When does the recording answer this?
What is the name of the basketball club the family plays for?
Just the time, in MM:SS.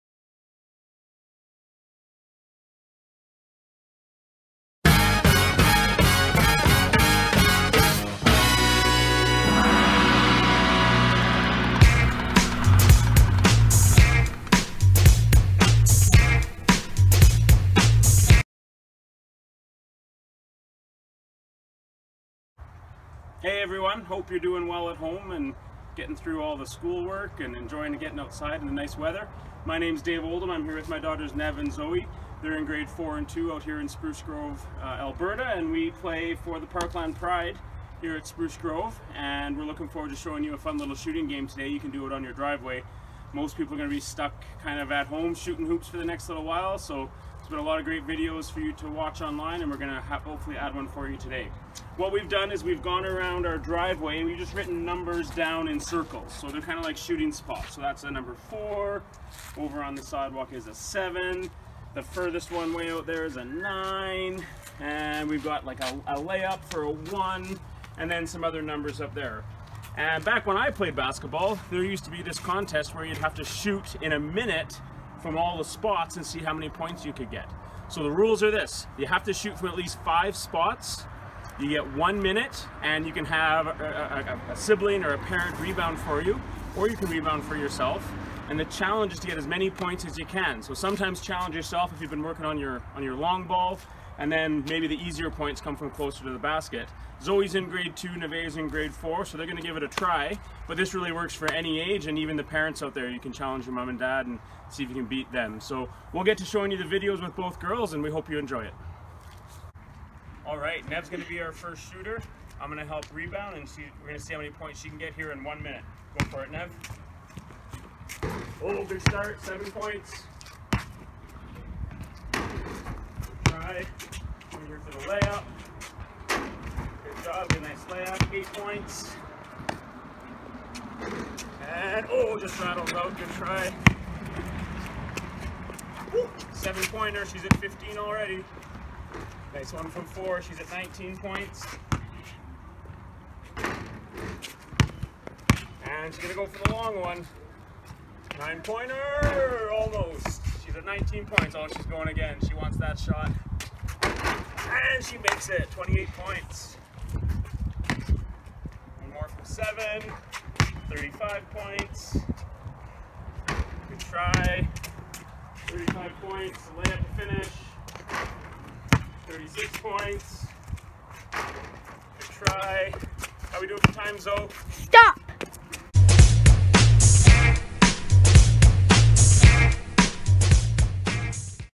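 00:36.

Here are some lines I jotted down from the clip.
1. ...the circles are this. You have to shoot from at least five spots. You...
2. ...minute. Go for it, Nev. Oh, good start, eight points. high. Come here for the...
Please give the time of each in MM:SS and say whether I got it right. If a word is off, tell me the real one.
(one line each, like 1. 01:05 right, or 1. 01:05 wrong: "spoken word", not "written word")
1. 01:18 wrong: "rules", not "circles"
2. 01:55 wrong: "seven", not "eight".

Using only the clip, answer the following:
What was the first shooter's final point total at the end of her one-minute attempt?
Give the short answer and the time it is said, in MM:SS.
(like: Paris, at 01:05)
36, at 02:49.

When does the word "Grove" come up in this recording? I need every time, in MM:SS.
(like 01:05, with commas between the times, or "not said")
00:34, 00:38.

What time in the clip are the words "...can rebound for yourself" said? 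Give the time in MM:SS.
01:26.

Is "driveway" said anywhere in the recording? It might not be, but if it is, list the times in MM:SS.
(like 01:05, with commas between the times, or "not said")
00:42, 00:53.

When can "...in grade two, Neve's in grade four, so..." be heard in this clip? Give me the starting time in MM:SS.
01:37.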